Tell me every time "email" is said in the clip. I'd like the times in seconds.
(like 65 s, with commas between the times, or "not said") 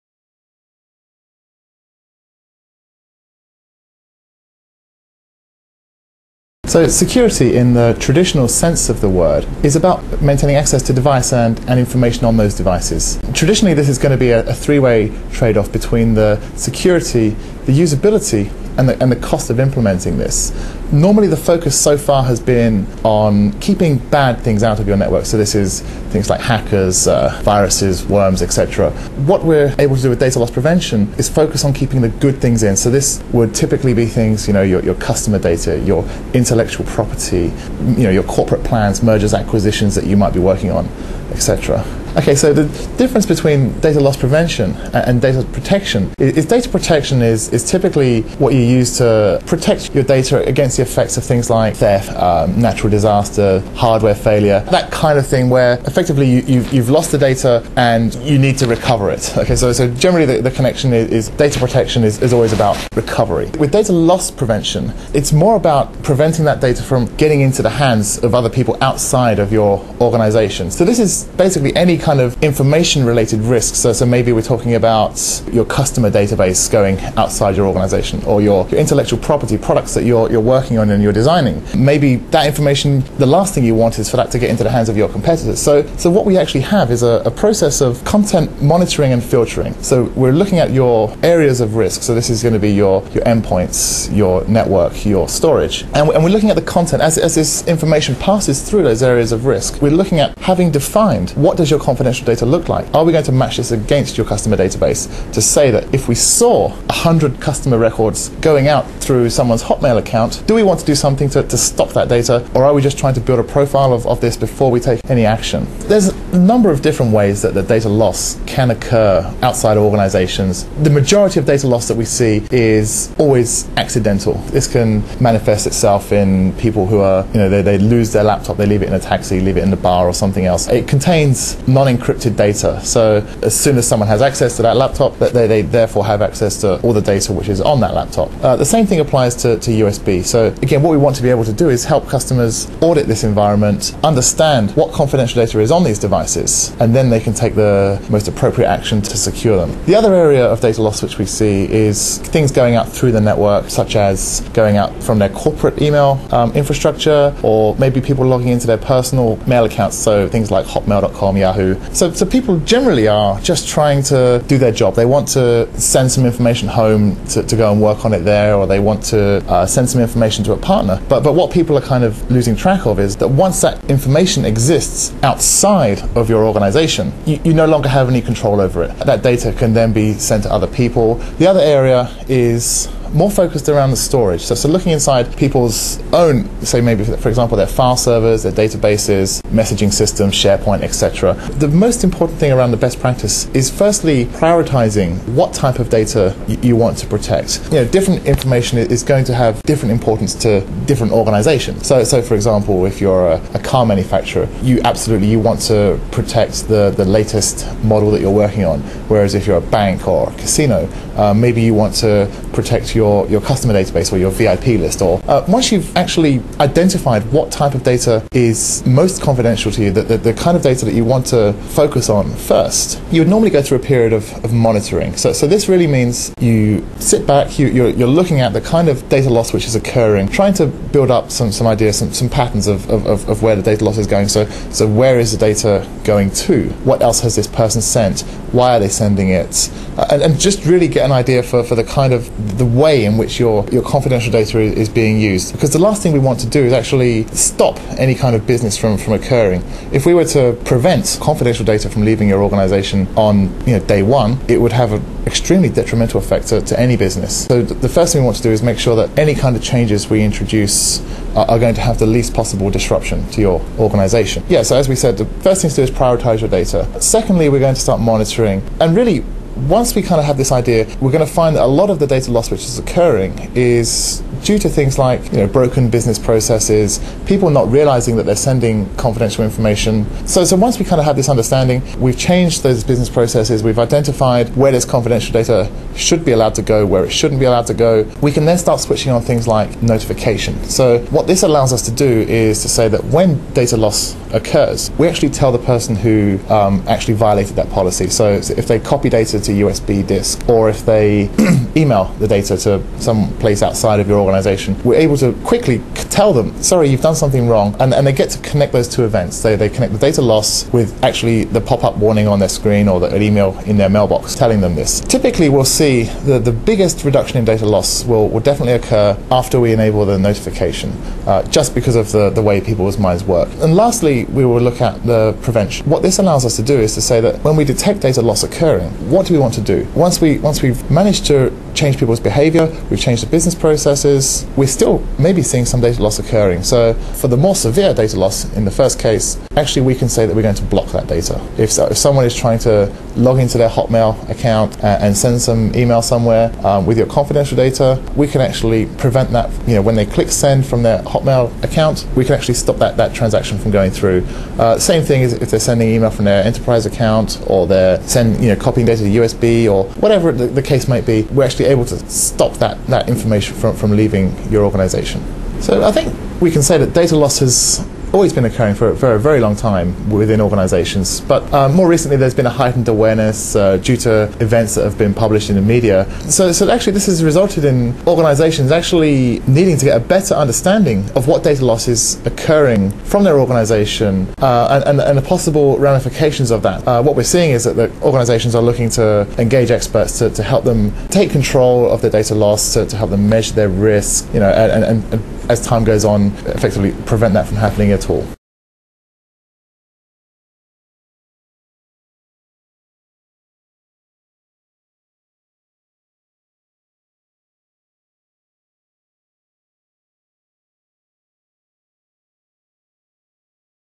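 155 s, 301 s, 313 s, 345 s, 355 s.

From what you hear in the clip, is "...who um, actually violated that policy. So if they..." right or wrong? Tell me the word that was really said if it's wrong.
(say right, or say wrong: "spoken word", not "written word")
right.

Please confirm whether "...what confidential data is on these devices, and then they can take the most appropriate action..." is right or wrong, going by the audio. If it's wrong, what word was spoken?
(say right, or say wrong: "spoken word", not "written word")
right.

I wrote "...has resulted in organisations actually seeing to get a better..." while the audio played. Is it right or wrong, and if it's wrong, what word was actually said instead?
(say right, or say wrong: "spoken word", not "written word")
wrong: "needing", not "seeing".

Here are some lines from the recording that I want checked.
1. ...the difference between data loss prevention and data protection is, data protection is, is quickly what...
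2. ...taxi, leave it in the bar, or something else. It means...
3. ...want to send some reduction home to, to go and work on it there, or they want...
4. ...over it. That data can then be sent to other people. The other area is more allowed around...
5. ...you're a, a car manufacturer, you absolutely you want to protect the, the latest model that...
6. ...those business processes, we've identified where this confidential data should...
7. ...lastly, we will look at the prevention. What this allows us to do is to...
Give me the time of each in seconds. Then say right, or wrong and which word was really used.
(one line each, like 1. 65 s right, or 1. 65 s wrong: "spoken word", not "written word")
1. 42 s wrong: "typically", not "quickly"
2. 128 s wrong: "contains", not "means"
3. 165 s wrong: "information", not "reduction"
4. 178 s wrong: "focused", not "allowed"
5. 203 s right
6. 282 s right
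7. 323 s right.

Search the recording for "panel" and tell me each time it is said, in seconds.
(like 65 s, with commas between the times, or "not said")
not said.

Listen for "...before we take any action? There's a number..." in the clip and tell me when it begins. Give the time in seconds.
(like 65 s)
114 s.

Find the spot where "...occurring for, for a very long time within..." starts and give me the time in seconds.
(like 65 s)
368 s.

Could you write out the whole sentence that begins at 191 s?
The most important thing around the best practice is firstly prioritizing what type of data y- you want to protect.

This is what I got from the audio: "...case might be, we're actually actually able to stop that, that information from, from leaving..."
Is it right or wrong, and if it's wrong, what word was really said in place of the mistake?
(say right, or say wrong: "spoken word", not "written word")
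right.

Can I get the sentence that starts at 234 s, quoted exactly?
So, so where is the data going to?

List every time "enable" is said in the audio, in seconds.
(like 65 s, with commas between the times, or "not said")
319 s.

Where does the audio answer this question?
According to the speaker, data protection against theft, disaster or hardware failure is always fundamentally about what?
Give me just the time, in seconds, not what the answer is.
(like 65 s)
62 s.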